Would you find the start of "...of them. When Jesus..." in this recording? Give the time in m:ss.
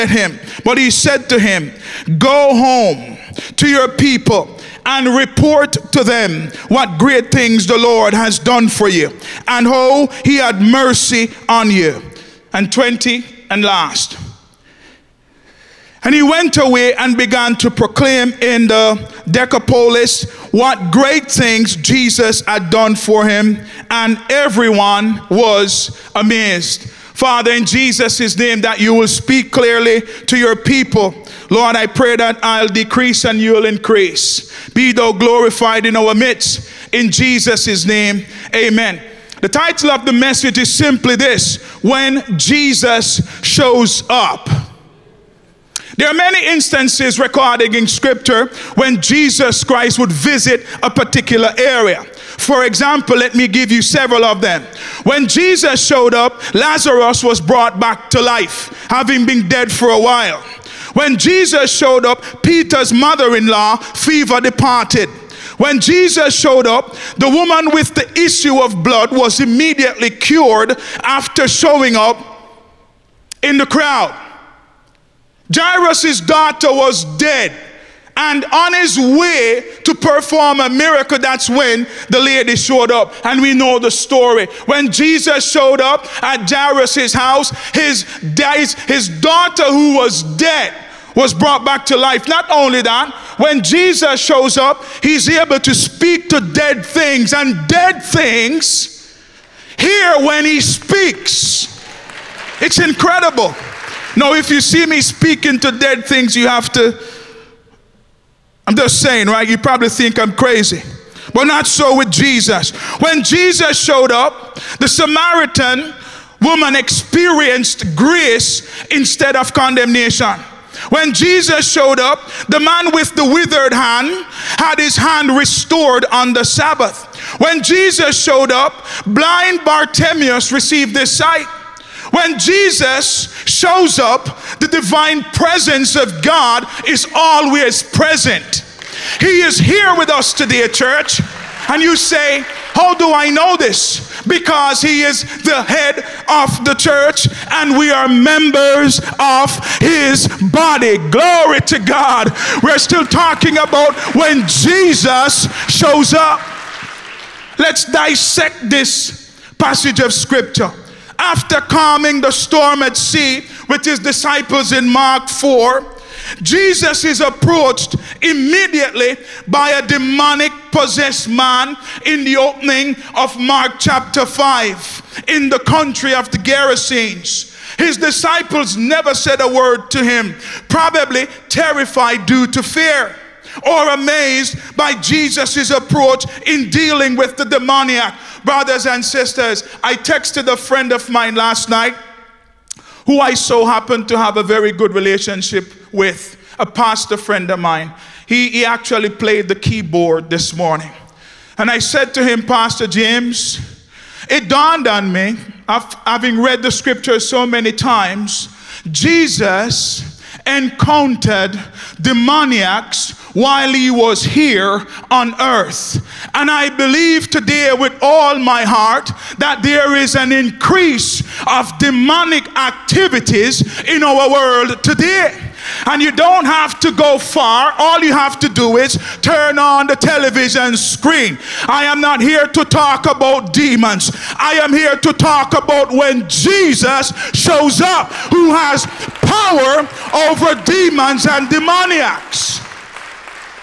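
0:54.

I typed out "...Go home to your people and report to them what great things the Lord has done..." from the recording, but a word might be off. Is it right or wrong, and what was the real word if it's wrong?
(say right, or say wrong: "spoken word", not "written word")
right.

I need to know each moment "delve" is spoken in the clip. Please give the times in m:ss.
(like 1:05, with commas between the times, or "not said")
not said.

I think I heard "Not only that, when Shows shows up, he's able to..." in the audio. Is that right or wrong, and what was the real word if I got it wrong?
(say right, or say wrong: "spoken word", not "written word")
wrong: "Jesus", not "Shows".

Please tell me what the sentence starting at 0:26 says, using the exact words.
Father, in Jesus' name, that you will speak clearly to your people.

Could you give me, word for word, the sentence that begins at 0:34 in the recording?
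Be thou glorified in our midst.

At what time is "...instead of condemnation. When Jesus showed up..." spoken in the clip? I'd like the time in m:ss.
1:58.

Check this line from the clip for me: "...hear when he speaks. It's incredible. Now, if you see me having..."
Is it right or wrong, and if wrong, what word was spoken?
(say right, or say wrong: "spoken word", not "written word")
wrong: "speaking", not "having".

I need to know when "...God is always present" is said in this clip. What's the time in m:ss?
2:16.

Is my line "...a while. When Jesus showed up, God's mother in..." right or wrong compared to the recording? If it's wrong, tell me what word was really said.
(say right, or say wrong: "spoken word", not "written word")
wrong: "Peter", not "God".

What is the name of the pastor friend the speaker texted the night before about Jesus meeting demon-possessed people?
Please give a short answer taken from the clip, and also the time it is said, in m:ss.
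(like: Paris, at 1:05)
Pastor James, at 3:22.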